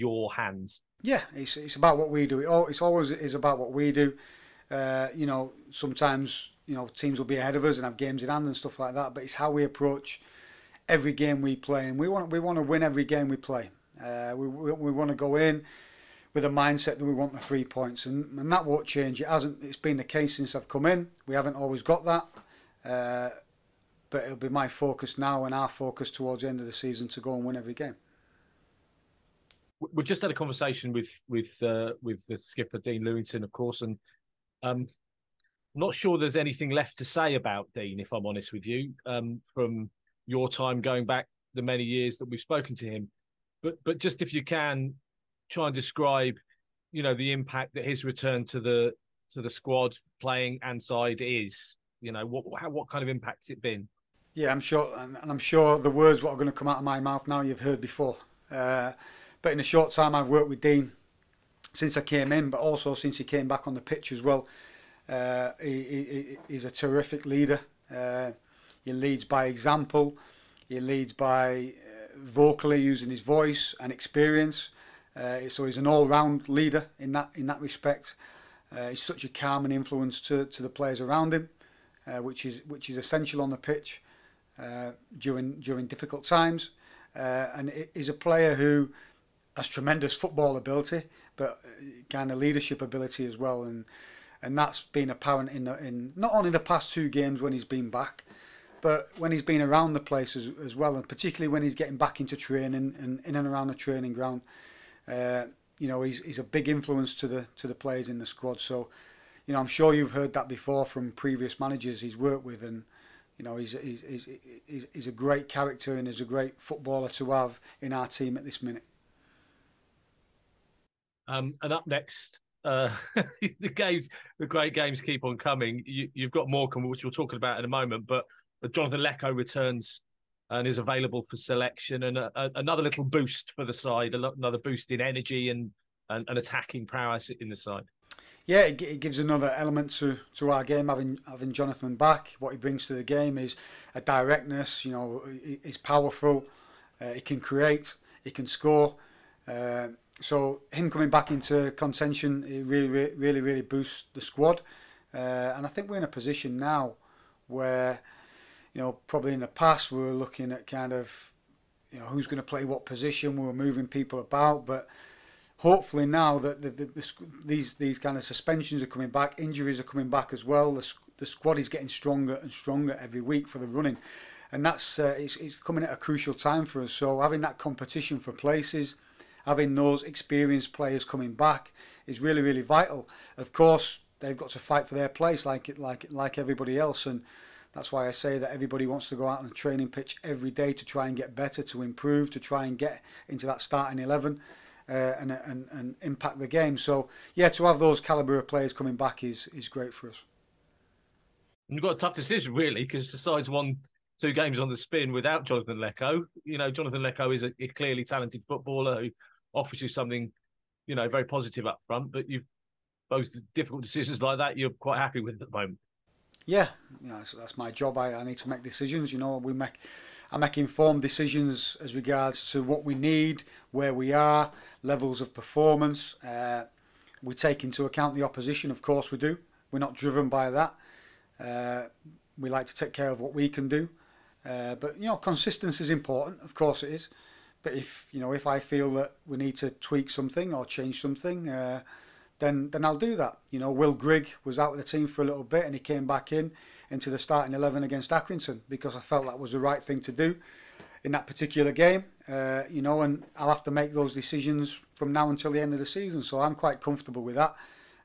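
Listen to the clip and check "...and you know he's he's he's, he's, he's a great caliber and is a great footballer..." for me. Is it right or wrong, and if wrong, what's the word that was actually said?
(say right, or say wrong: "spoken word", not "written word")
wrong: "character", not "caliber".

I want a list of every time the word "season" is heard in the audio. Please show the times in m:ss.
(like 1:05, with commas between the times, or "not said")
0:26, 4:15.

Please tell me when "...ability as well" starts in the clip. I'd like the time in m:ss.
1:32.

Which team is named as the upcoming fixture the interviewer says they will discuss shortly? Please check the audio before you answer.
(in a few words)
Morecambe.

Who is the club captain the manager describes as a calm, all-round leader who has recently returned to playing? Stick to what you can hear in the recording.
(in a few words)
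Dean Lewington.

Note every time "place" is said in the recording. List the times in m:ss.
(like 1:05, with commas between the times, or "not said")
1:40, 2:58, 3:05.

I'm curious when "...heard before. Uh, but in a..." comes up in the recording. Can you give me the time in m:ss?
0:57.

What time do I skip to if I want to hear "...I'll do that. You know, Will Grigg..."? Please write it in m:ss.
4:02.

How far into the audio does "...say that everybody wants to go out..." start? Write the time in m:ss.
3:08.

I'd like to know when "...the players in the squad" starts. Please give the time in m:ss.
1:47.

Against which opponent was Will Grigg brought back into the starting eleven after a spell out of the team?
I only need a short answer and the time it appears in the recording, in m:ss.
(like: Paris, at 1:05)
Accrington, at 4:08.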